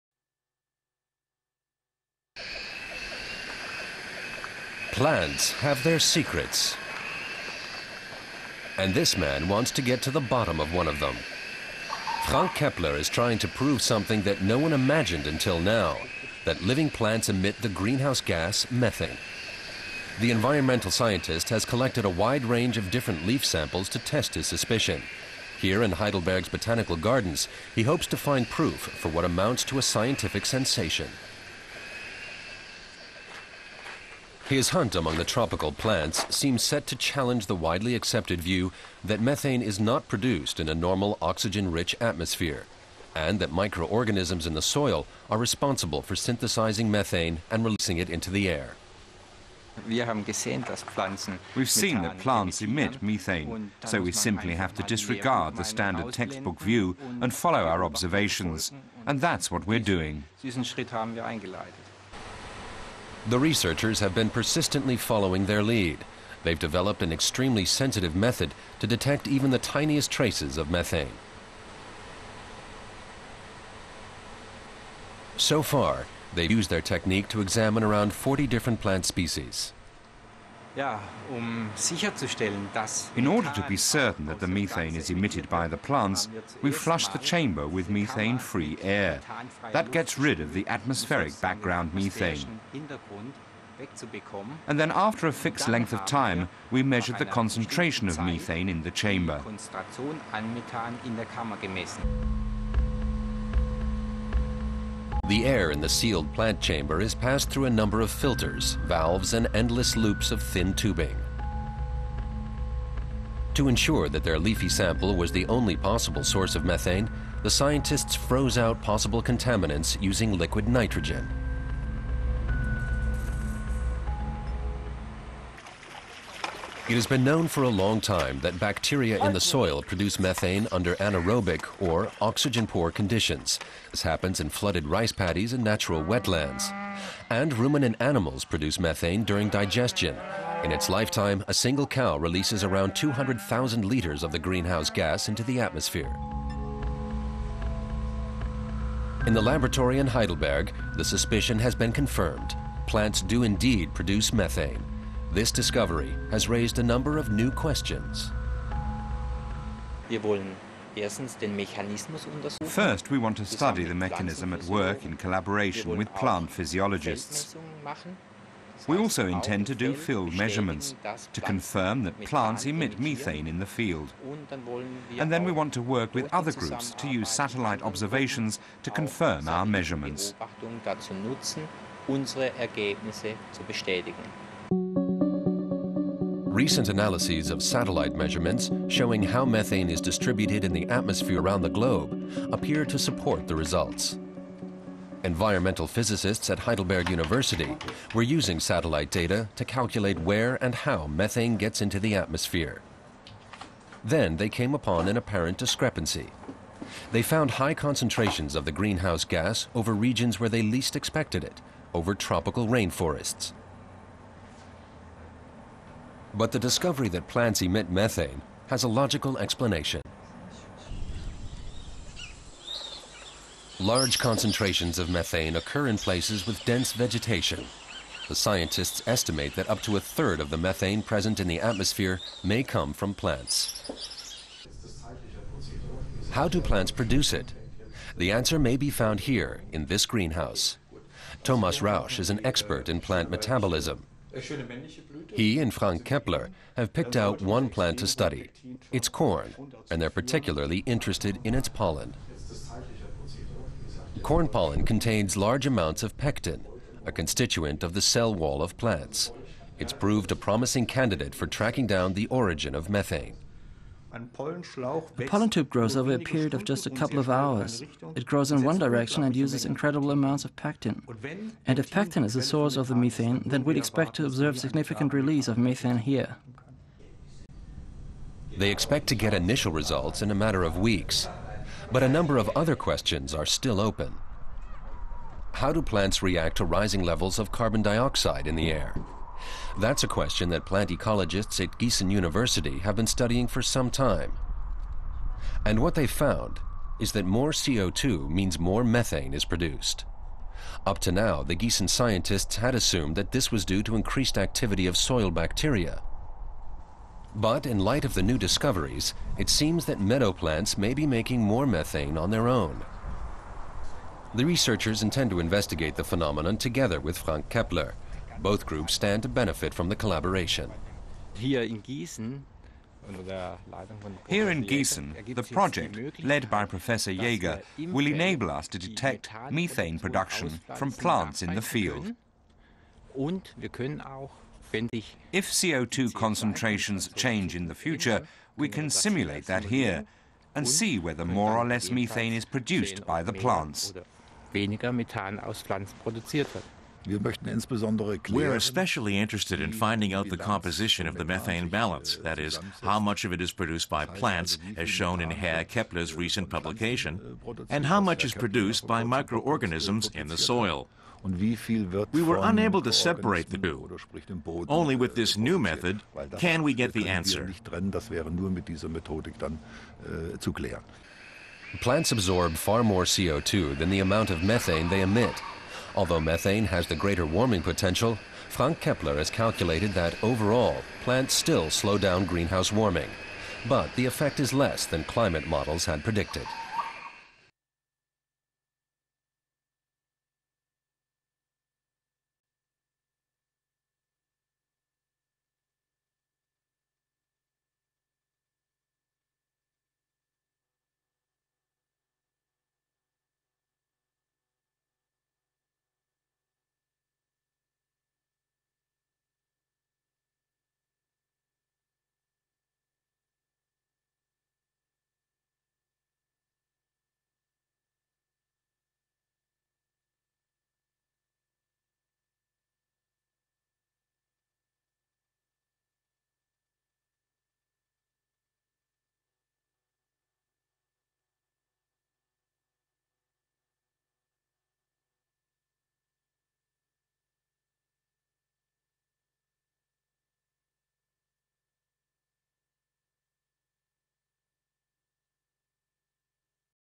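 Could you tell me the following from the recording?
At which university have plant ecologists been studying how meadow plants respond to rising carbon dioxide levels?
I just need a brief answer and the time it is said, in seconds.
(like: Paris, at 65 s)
Giessen University, at 291 s.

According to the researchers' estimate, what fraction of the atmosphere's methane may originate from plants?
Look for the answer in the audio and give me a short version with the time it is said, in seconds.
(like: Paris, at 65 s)
up to a third, at 229 s.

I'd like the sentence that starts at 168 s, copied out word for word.
We also intend to do field measurements to confirm that plants emit methane in the field.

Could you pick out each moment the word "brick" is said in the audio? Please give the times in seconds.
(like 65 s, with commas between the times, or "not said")
not said.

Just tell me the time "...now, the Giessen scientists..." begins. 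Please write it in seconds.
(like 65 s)
301 s.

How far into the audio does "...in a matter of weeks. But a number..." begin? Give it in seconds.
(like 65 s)
280 s.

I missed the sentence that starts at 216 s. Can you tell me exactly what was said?
But the discovery that plants emit methane has a logical explanation.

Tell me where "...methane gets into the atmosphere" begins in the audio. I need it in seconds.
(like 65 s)
201 s.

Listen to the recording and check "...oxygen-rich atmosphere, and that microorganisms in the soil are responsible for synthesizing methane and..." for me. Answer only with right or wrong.
right.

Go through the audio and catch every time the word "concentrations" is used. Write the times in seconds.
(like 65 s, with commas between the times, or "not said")
97 s, 207 s, 224 s, 336 s.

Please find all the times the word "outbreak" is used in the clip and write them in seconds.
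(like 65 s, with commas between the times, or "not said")
not said.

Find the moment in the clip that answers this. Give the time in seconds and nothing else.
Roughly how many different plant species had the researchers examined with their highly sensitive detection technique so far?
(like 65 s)
77 s.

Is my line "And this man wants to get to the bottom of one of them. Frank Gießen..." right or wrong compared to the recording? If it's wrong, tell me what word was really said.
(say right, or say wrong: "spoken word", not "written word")
wrong: "Keppler", not "Gießen".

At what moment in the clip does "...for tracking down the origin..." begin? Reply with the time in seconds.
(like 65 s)
261 s.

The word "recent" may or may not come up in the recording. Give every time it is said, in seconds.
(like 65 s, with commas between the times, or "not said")
186 s, 356 s.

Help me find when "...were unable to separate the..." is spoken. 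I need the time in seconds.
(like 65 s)
362 s.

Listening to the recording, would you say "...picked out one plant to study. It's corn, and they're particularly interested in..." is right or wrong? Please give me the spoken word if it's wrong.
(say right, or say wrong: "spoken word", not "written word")
right.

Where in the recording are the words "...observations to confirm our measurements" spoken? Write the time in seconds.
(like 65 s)
177 s.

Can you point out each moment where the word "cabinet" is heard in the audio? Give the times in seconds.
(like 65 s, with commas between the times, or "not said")
not said.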